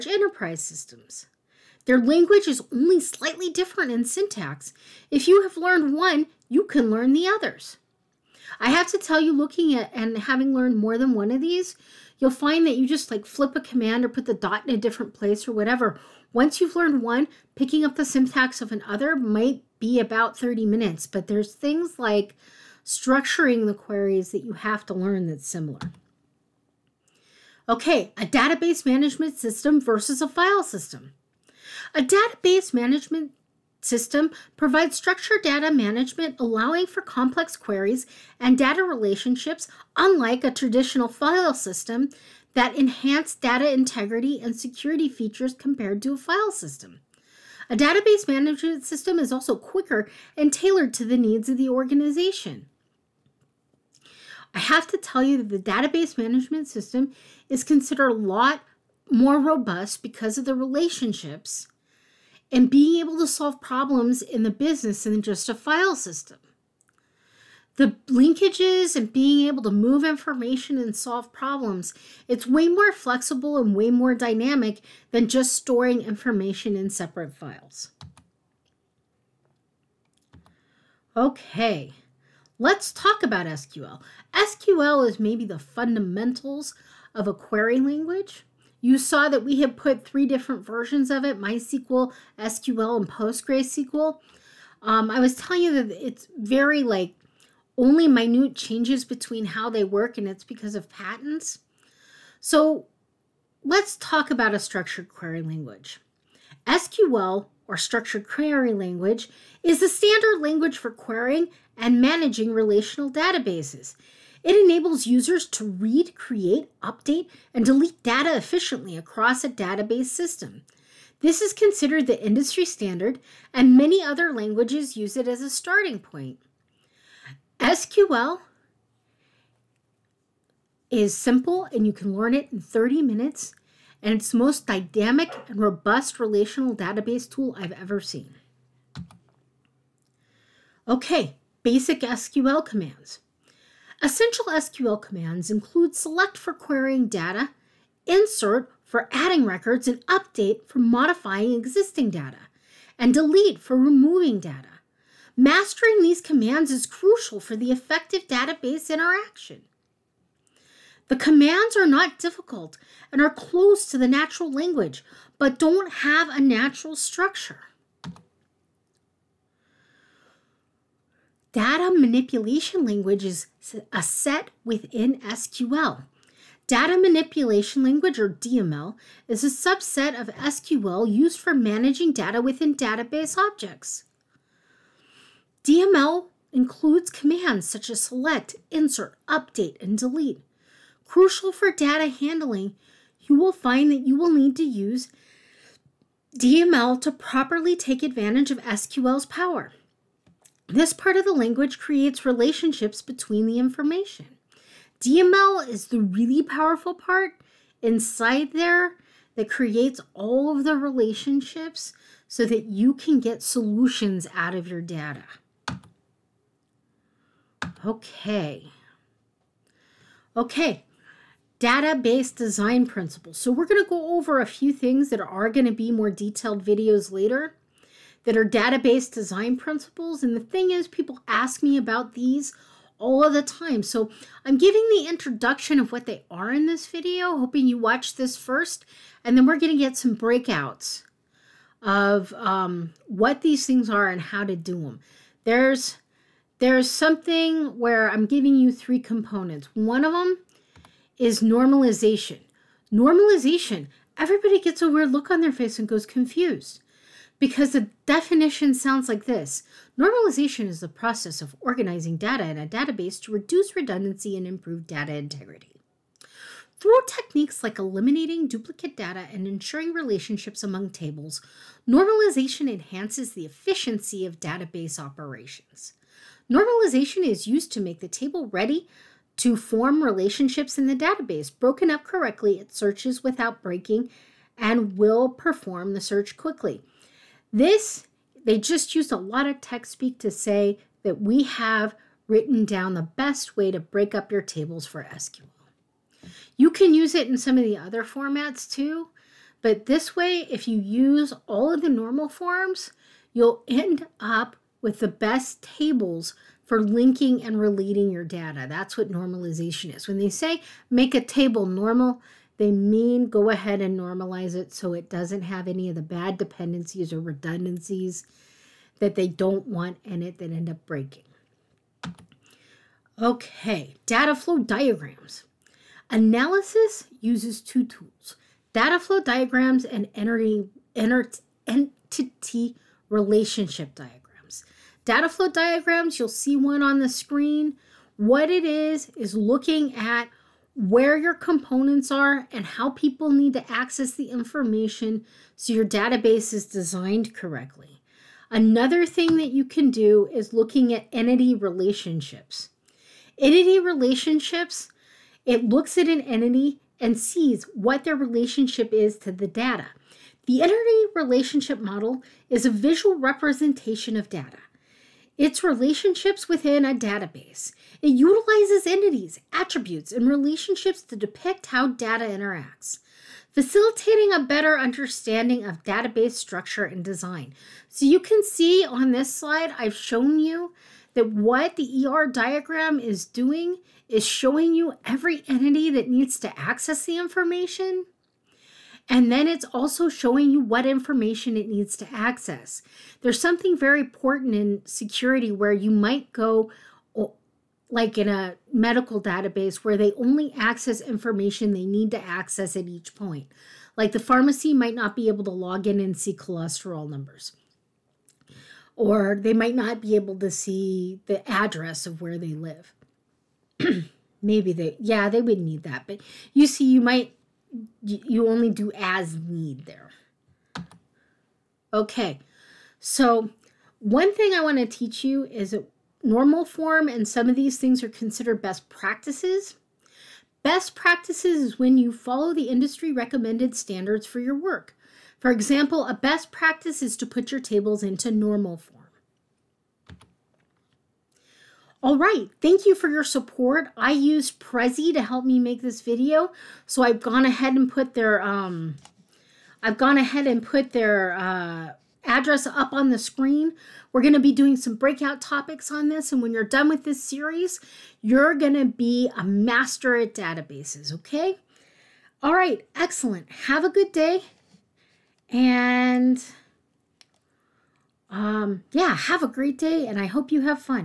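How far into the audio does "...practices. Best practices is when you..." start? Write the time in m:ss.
7:08.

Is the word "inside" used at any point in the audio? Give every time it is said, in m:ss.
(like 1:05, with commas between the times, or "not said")
3:27.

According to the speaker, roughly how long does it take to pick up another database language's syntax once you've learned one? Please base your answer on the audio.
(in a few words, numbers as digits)
30 minutes.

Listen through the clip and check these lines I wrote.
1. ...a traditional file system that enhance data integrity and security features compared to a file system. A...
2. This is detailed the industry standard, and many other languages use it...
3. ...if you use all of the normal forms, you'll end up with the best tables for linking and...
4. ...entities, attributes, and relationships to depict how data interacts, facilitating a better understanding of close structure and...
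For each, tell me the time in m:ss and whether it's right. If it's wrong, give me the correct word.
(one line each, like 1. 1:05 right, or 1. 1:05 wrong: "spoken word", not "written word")
1. 0:40 right
2. 2:01 wrong: "considered", not "detailed"
3. 5:00 right
4. 6:08 wrong: "database", not "close".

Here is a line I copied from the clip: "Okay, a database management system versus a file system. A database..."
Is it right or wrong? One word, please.
right.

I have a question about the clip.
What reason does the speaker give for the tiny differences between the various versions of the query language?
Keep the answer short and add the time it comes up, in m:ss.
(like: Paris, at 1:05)
patents, at 1:40.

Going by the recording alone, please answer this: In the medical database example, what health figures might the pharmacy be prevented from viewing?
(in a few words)
cholesterol numbers.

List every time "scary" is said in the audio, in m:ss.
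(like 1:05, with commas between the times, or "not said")
not said.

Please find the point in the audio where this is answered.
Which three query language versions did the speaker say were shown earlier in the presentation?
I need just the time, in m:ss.
1:31.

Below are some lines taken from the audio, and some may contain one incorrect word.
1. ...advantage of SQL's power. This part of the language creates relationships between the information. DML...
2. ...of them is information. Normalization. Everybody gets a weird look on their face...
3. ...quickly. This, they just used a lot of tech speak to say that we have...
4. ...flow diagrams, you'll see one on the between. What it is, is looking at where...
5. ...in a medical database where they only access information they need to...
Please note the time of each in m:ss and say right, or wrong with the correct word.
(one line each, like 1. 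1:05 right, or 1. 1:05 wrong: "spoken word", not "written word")
1. 3:18 right
2. 4:10 wrong: "normalization", not "information"
3. 4:46 right
4. 5:35 wrong: "screen", not "between"
5. 6:38 right.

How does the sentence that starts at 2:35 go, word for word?
Mastering these commands is crucial for the effective database interaction.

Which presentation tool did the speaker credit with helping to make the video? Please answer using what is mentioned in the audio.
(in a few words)
Prezi.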